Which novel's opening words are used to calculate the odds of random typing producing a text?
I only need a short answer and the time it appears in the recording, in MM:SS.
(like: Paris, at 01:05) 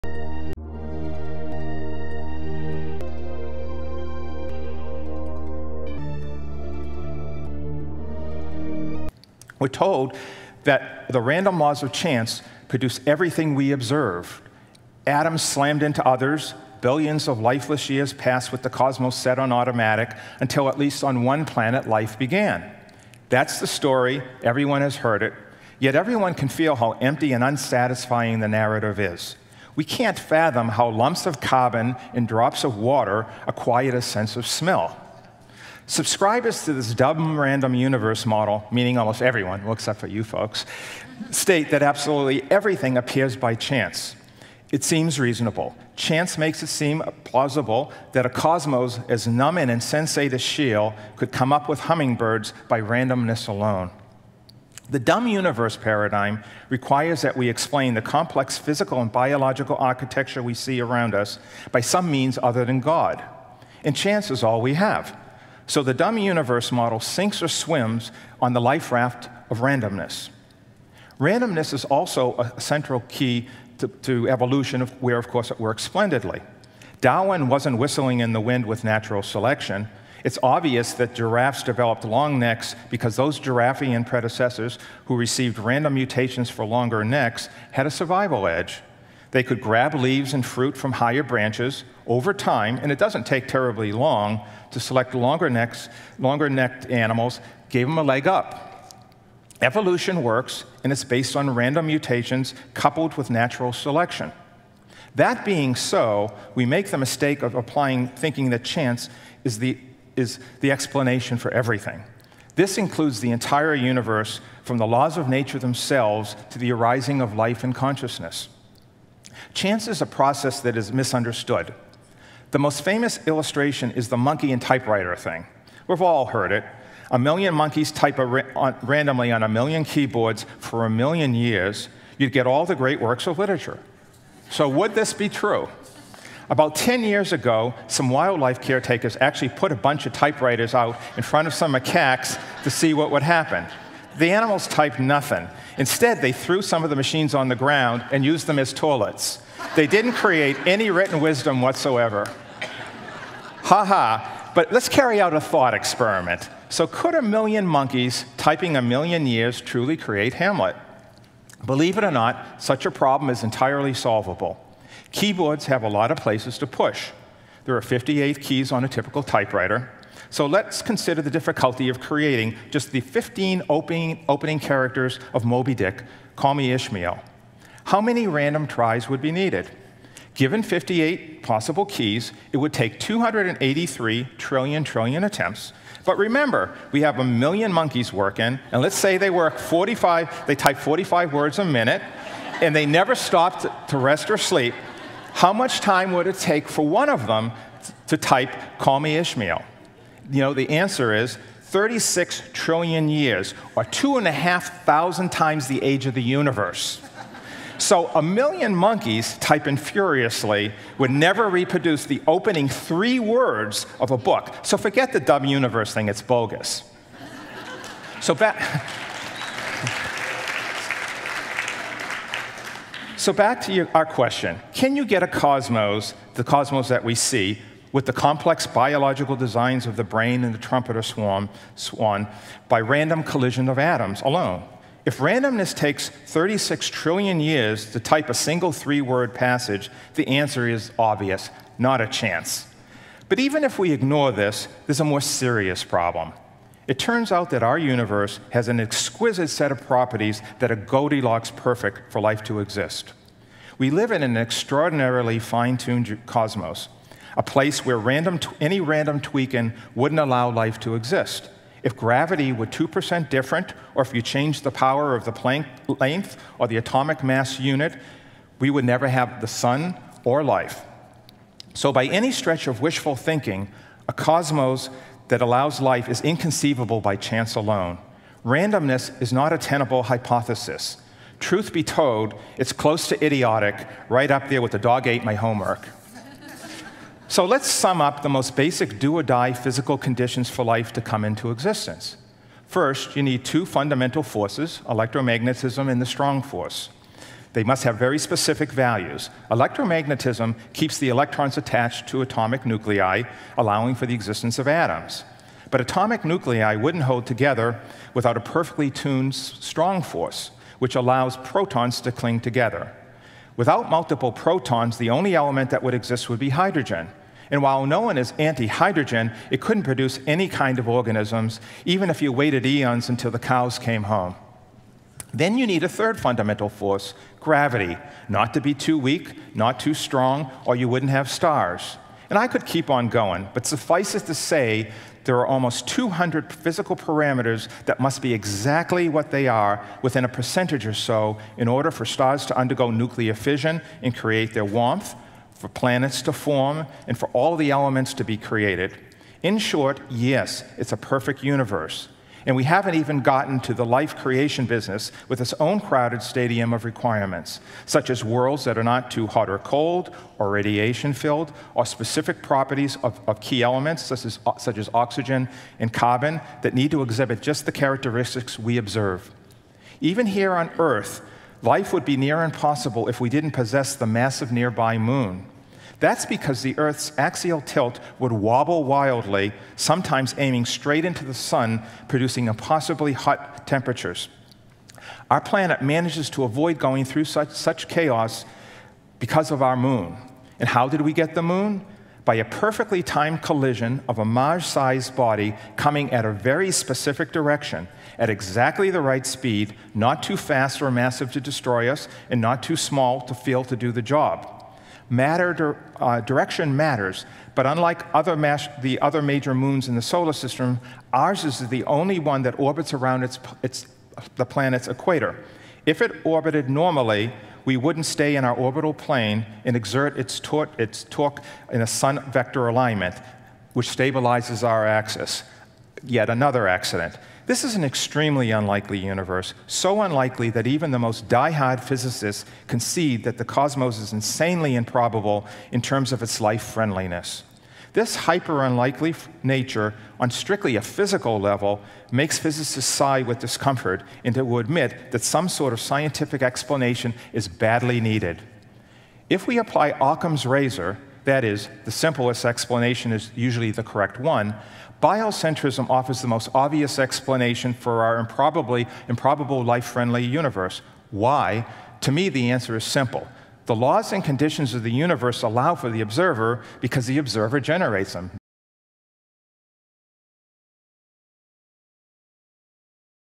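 Moby Dick, at 02:55.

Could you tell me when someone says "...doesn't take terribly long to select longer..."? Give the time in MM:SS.
01:32.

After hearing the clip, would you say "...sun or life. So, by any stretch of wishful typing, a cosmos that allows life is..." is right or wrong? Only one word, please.
wrong.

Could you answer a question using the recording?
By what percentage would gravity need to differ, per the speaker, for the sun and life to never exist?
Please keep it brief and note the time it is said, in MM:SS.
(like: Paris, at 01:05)
2%, at 04:22.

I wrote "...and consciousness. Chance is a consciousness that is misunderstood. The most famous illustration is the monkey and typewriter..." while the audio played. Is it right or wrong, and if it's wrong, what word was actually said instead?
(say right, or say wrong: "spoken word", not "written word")
wrong: "process", not "consciousness".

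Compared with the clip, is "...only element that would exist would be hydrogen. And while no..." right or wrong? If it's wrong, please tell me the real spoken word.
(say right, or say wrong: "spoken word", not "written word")
right.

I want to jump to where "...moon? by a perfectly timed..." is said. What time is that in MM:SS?
06:31.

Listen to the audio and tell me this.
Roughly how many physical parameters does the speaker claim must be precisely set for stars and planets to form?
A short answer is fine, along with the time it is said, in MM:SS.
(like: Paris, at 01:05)
almost 200, at 05:35.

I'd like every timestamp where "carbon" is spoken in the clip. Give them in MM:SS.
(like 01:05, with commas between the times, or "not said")
00:31, 06:05.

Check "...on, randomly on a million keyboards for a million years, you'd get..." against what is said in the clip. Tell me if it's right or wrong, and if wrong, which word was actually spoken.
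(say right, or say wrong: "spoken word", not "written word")
right.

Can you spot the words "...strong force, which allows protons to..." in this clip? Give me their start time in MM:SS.
05:09.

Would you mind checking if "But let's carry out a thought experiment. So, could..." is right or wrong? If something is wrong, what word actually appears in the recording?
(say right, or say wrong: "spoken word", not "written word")
right.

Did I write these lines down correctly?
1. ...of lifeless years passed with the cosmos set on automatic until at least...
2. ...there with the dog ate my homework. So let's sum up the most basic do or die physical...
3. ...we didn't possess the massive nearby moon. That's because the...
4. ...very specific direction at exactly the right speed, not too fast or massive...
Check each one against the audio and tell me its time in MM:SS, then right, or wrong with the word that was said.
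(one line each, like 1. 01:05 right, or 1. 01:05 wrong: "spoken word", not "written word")
1. 00:17 right
2. 04:44 right
3. 06:13 right
4. 06:36 right.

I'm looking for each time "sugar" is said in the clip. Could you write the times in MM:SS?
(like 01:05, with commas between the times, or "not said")
not said.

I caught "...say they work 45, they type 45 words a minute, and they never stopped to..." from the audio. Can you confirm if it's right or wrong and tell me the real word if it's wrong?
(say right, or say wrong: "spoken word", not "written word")
right.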